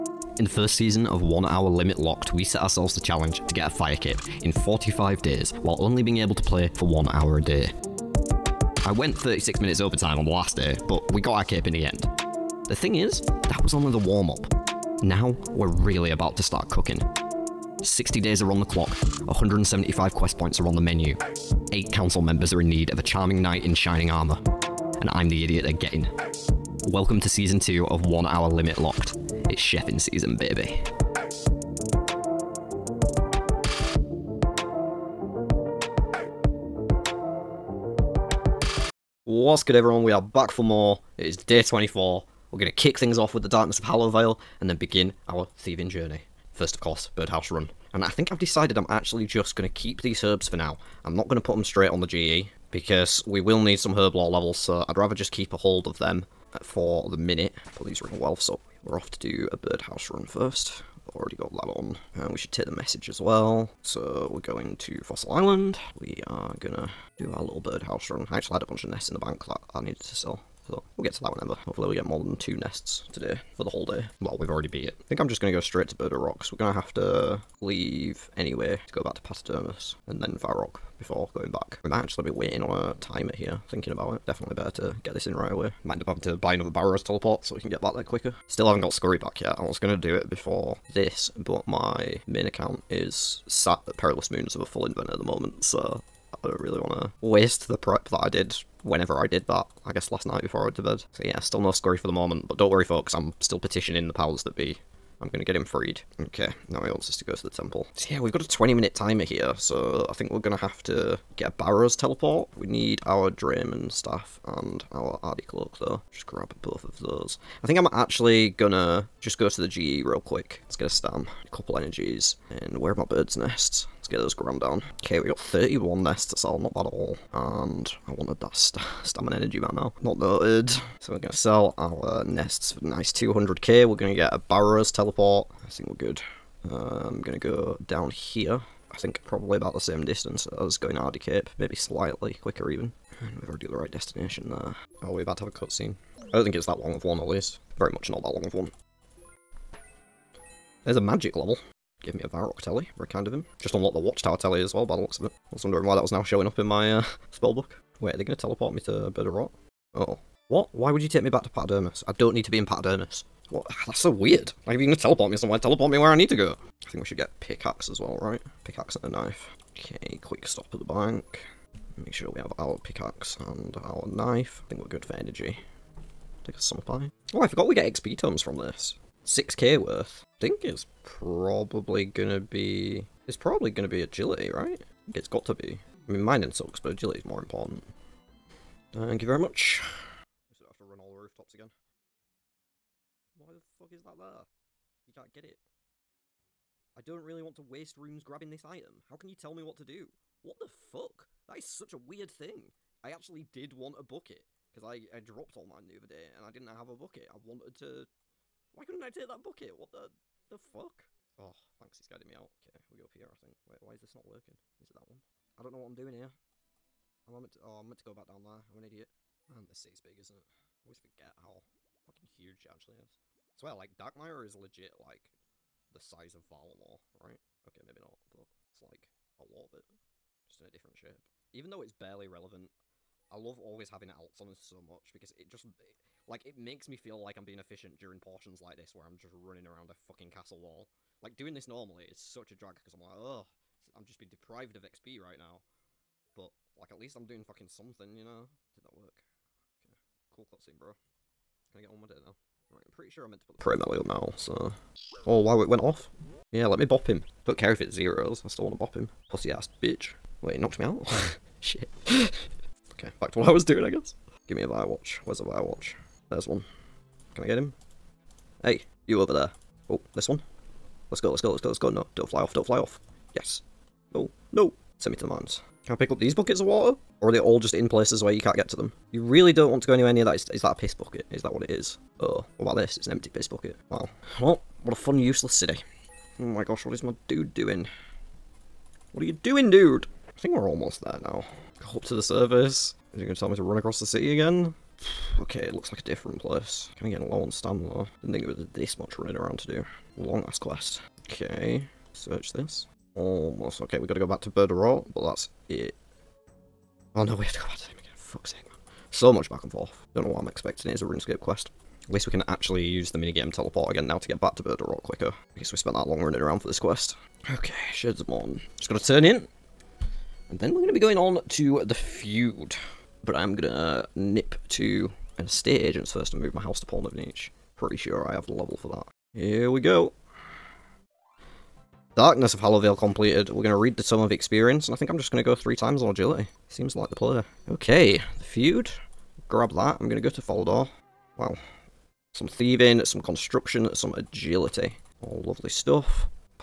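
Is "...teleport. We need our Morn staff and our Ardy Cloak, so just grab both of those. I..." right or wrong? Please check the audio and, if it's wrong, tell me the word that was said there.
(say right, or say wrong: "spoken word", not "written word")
wrong: "Dramen", not "Morn".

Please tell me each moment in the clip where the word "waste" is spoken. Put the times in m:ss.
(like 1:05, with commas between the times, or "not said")
1:37, 3:17.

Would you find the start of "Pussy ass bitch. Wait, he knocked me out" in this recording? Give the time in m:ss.
4:19.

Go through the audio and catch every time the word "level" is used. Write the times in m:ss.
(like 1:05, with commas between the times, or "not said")
0:54, 2:31, 5:28.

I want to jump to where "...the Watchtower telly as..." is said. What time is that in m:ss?
2:33.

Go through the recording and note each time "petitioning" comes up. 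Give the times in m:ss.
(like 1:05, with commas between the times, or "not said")
1:43.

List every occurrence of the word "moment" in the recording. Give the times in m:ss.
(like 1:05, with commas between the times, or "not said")
1:35, 1:42.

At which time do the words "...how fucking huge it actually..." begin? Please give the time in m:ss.
3:41.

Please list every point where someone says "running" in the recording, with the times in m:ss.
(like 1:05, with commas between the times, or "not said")
3:59, 4:59, 5:16.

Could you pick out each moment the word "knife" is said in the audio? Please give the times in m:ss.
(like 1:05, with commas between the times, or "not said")
2:49, 2:54.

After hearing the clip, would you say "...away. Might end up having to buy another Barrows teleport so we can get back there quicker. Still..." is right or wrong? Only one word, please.
right.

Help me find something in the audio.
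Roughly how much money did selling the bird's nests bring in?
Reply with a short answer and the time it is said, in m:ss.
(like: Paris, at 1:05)
200k, at 2:13.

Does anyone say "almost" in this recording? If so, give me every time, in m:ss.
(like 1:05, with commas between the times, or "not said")
4:50, 5:03.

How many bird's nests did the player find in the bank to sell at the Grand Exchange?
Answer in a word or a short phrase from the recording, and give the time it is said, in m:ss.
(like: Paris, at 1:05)
31, at 2:05.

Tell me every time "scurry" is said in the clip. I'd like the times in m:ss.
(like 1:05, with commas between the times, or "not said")
1:28, 1:41.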